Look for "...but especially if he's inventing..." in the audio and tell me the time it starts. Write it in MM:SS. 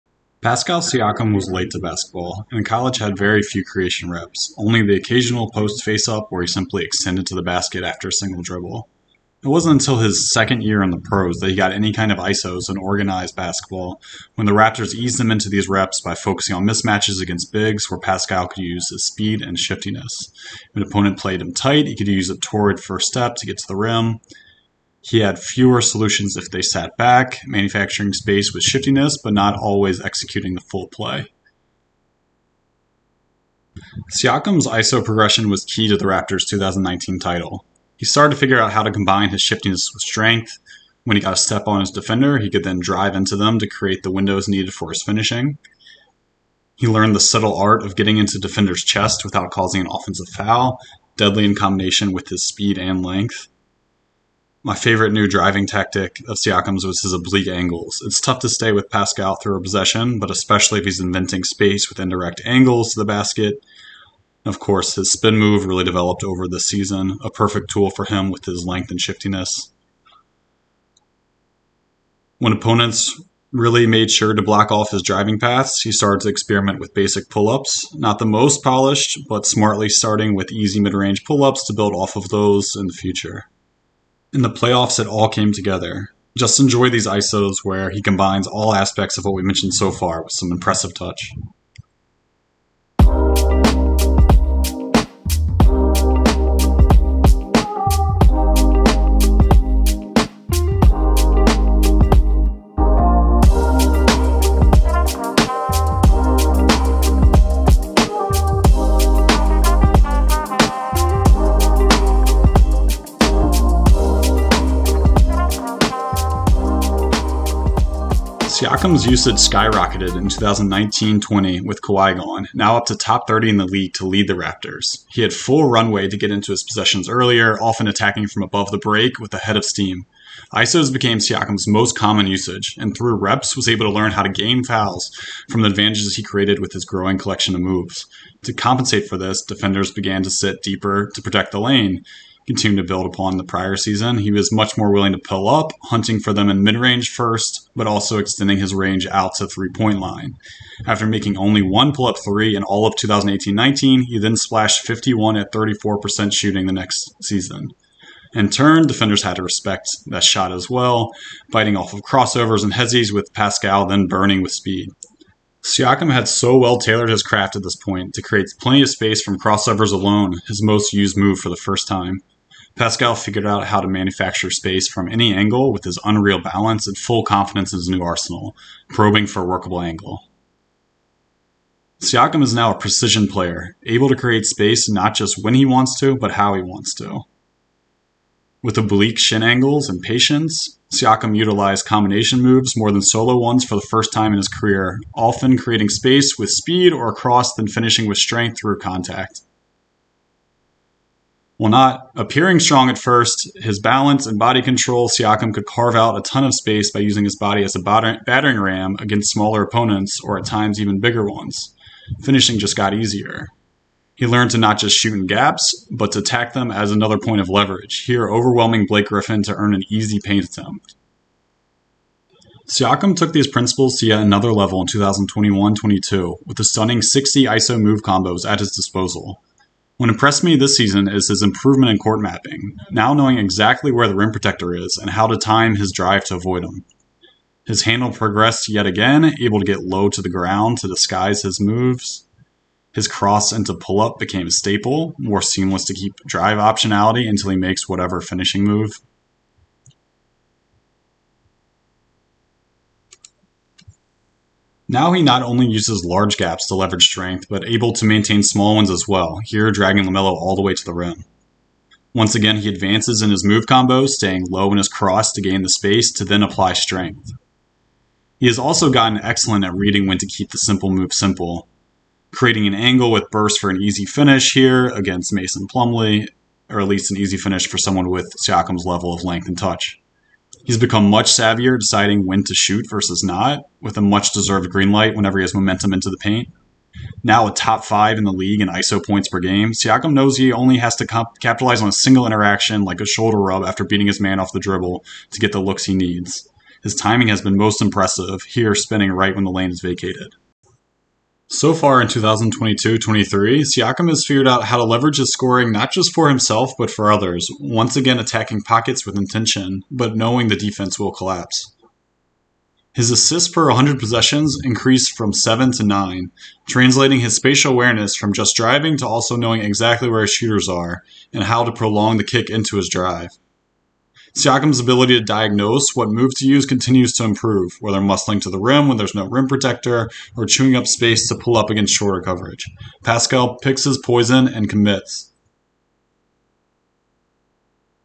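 01:00.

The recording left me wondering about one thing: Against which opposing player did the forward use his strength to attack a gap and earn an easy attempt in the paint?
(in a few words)
Blake Griffin.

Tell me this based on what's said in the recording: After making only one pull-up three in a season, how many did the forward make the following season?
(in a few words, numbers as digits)
51.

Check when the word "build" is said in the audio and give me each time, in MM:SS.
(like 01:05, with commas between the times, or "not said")
01:21, 02:22.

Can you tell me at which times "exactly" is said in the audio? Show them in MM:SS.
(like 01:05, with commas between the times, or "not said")
03:53, 05:19.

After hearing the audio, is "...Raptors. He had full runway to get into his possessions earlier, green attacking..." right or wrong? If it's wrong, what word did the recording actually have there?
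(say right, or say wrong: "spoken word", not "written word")
wrong: "often", not "green".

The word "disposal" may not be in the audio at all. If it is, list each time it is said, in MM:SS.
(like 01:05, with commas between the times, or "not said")
03:48.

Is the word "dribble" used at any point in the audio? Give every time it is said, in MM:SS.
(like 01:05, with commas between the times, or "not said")
00:08, 04:54.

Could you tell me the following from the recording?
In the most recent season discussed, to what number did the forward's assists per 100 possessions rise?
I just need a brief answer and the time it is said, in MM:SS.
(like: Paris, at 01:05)
9, at 05:15.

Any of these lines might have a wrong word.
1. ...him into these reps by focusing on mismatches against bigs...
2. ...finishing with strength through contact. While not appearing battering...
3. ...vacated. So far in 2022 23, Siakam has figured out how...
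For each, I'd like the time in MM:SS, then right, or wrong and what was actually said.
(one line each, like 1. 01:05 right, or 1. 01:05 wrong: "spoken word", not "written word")
1. 00:15 right
2. 03:17 wrong: "strong", not "battering"
3. 04:59 right.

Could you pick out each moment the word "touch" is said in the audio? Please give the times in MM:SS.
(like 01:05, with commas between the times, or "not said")
01:30, 04:39.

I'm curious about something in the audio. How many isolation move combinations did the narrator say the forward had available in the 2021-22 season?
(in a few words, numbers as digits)
60.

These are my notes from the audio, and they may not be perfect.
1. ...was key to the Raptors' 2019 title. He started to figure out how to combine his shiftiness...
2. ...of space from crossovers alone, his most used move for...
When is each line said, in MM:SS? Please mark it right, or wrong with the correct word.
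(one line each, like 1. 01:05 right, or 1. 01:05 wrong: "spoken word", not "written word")
1. 00:35 right
2. 02:48 right.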